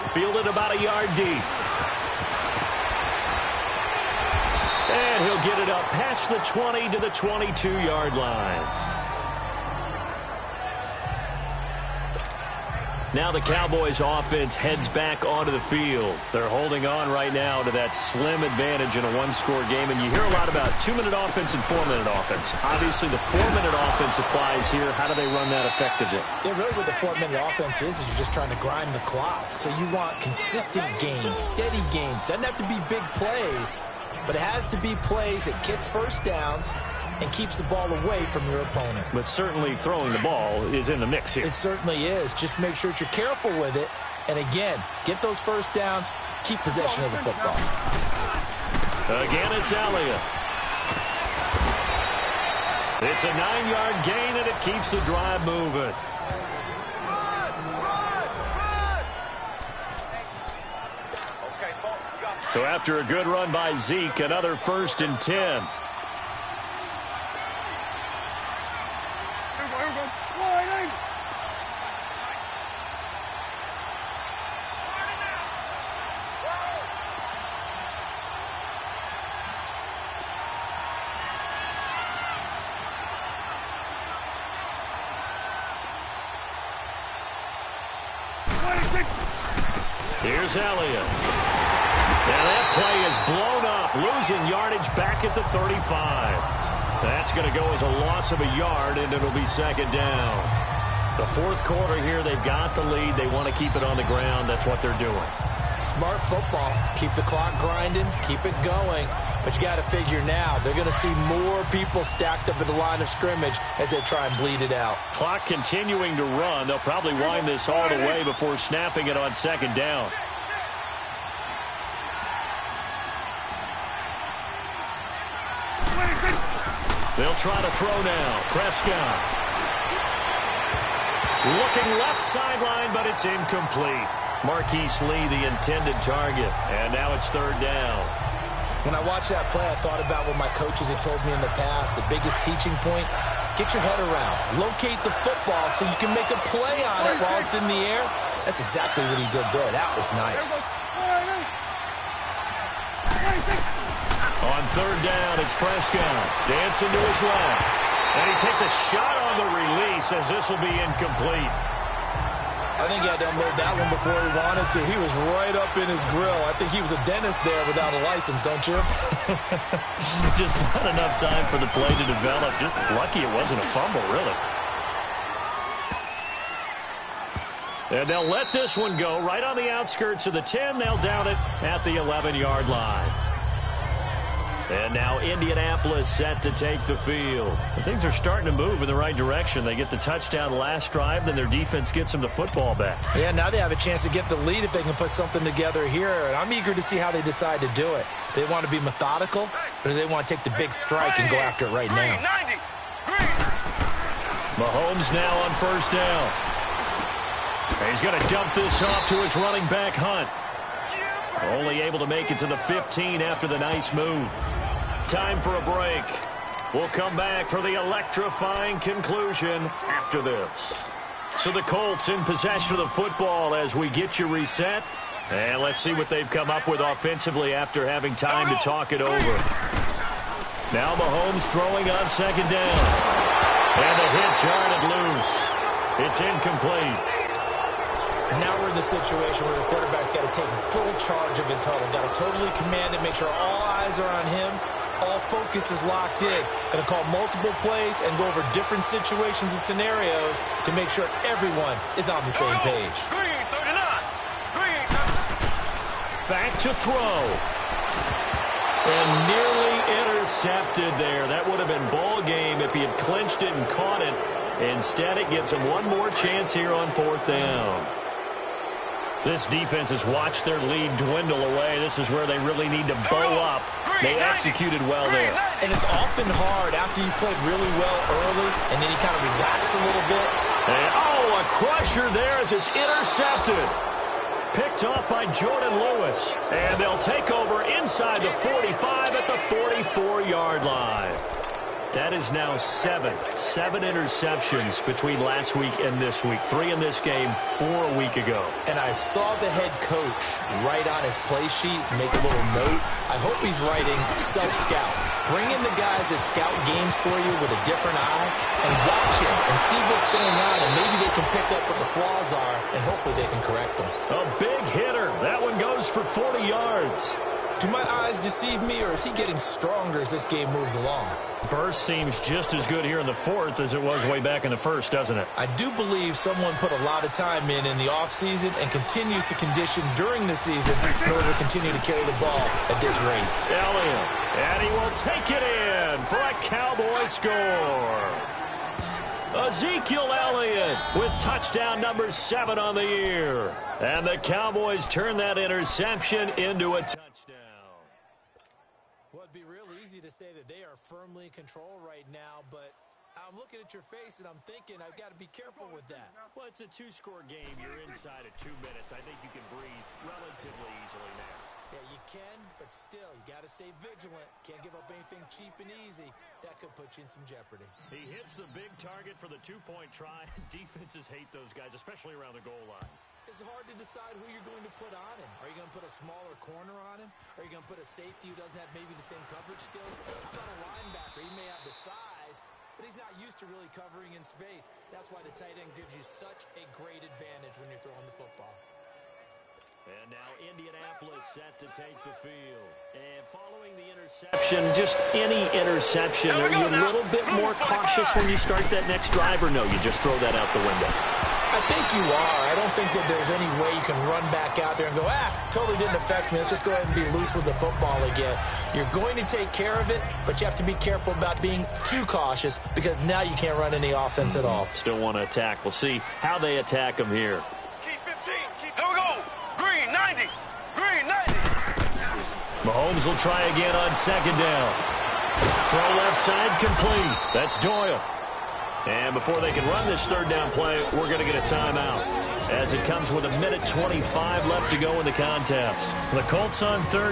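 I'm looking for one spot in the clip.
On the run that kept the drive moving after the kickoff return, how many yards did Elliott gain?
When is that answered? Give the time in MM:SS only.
00:53.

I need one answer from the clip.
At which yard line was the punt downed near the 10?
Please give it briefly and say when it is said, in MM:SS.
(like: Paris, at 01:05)
11, at 03:01.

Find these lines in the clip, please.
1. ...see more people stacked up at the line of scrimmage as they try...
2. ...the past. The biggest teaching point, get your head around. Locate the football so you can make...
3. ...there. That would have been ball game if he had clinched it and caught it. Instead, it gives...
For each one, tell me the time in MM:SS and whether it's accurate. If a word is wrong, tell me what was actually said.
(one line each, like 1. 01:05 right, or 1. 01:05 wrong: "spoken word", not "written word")
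1. 01:50 right
2. 02:21 right
3. 04:20 right.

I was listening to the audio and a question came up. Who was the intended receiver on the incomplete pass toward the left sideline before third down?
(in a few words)
Marquise Lee.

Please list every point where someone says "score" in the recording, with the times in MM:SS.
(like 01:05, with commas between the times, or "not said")
00:19, 05:37, 05:56.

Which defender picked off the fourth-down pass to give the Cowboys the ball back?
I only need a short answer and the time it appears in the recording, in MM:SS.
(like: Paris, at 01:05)
Jourdan Lewis, at 04:45.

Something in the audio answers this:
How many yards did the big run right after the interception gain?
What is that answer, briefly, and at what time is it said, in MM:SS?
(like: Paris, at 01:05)
40, at 05:16.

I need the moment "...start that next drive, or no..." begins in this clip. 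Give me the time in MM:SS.
06:38.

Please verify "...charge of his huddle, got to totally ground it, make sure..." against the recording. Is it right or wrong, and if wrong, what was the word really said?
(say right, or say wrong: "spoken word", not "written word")
wrong: "command", not "ground".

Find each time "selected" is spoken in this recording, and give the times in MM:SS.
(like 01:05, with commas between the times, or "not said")
not said.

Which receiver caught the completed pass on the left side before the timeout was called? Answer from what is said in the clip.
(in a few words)
Doyle.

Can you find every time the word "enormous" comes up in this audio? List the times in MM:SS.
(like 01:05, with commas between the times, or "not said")
not said.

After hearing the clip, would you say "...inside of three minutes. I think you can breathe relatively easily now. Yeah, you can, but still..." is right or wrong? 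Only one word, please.
wrong.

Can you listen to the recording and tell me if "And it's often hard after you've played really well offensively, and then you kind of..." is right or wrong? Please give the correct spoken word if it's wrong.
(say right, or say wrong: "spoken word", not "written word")
wrong: "early", not "offensively".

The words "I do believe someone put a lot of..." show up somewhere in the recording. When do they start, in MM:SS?
05:25.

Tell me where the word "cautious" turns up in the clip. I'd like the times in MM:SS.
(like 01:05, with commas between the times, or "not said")
06:37, 06:52.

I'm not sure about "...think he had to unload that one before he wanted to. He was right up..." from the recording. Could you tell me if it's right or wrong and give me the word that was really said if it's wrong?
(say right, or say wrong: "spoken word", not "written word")
right.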